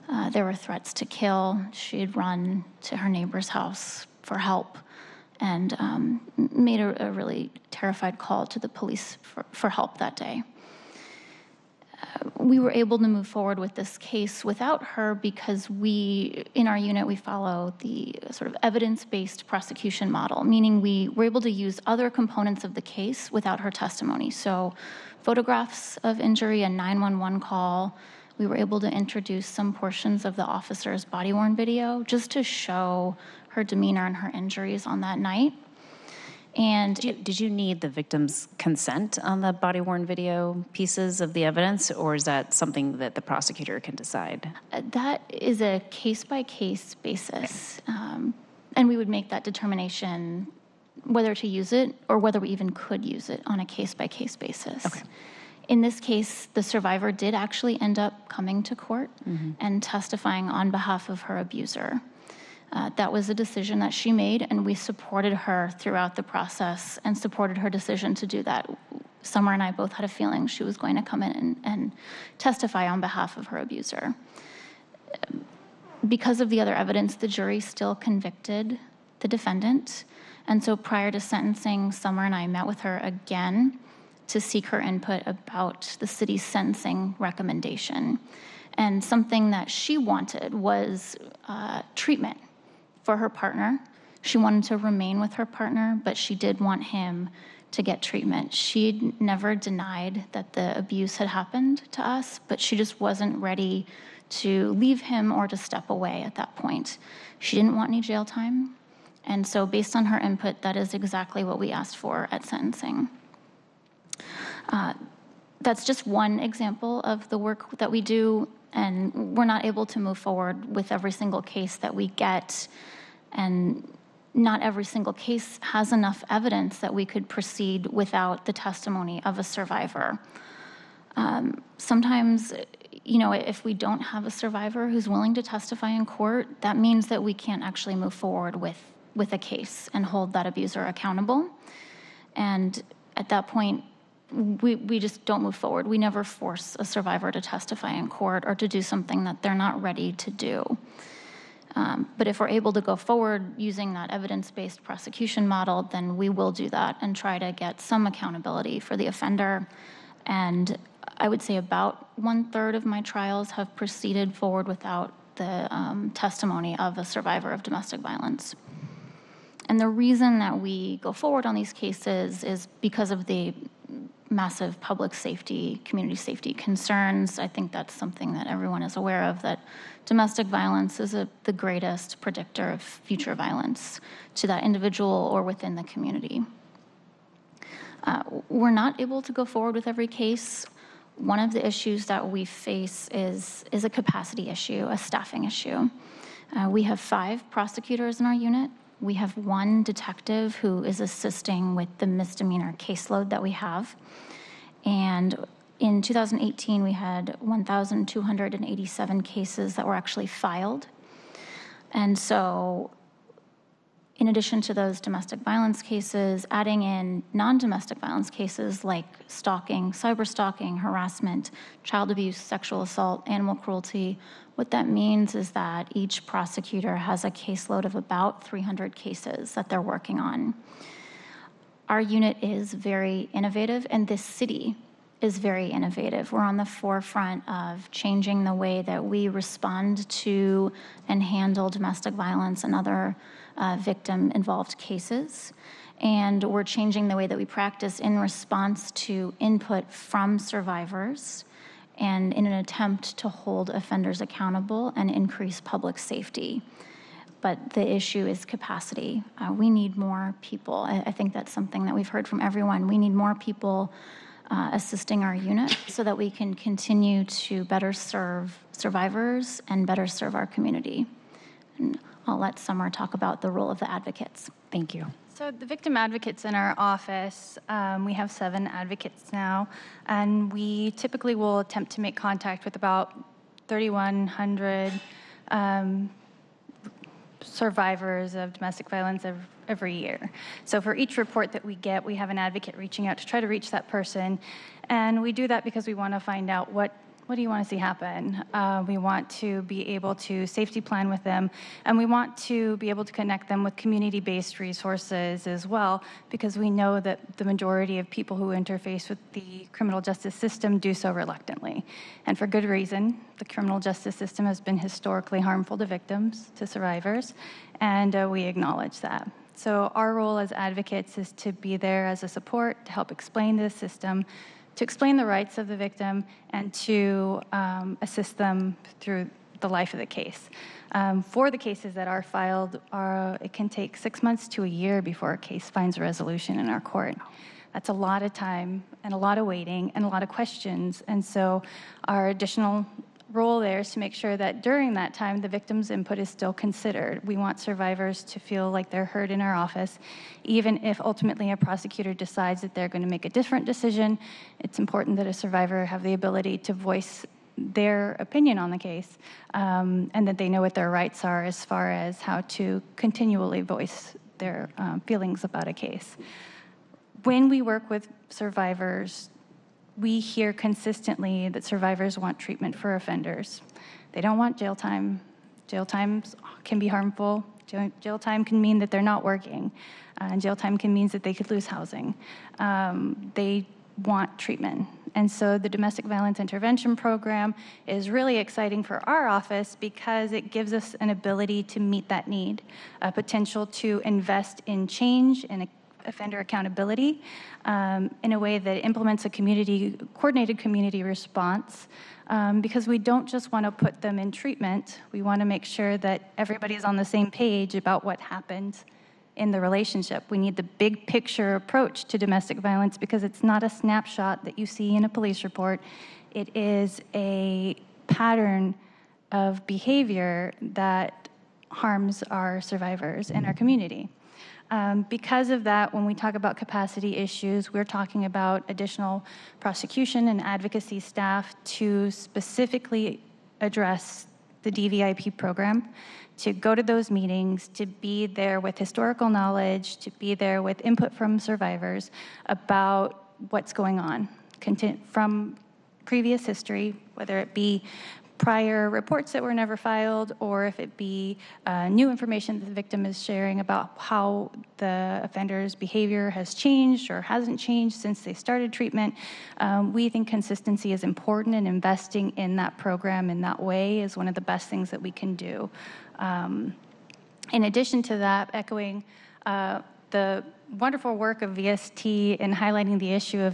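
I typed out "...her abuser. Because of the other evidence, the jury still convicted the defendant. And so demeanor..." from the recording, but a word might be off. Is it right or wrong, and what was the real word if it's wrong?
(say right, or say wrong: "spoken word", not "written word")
wrong: "prior", not "demeanor".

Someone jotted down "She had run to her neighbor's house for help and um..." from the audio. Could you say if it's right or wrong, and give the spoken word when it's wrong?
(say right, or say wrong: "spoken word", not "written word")
right.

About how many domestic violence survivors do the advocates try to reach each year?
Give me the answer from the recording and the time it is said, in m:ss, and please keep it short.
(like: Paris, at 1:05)
3,100, at 4:43.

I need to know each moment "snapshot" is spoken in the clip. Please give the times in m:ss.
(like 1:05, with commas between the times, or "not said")
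6:53.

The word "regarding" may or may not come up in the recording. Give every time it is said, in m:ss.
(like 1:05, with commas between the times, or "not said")
not said.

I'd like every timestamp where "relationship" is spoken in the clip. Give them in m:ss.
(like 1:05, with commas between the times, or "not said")
6:49.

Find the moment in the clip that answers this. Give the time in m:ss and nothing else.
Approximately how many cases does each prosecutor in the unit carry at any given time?
3:48.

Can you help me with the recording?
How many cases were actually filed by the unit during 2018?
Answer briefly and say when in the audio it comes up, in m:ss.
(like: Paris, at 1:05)
1,287, at 3:27.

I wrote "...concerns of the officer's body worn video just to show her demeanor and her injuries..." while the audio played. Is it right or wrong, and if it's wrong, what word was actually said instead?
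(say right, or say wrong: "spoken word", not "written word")
wrong: "portions", not "concerns".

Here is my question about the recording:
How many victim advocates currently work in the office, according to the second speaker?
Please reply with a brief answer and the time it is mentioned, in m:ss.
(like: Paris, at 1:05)
7, at 4:38.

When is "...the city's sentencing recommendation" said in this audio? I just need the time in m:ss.
1:25.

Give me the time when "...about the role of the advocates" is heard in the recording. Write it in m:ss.
4:33.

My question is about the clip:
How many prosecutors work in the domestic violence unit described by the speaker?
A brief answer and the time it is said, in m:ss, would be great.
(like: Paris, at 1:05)
5, at 3:16.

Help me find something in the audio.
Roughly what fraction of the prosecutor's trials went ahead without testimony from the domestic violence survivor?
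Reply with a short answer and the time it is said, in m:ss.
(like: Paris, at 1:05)
one third, at 2:42.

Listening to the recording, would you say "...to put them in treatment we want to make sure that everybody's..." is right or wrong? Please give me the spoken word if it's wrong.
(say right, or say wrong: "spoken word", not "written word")
right.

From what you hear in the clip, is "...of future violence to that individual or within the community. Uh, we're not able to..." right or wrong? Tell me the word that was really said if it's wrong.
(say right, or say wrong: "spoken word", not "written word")
right.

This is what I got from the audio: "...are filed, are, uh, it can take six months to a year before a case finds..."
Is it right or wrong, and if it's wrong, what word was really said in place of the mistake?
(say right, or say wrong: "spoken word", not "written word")
right.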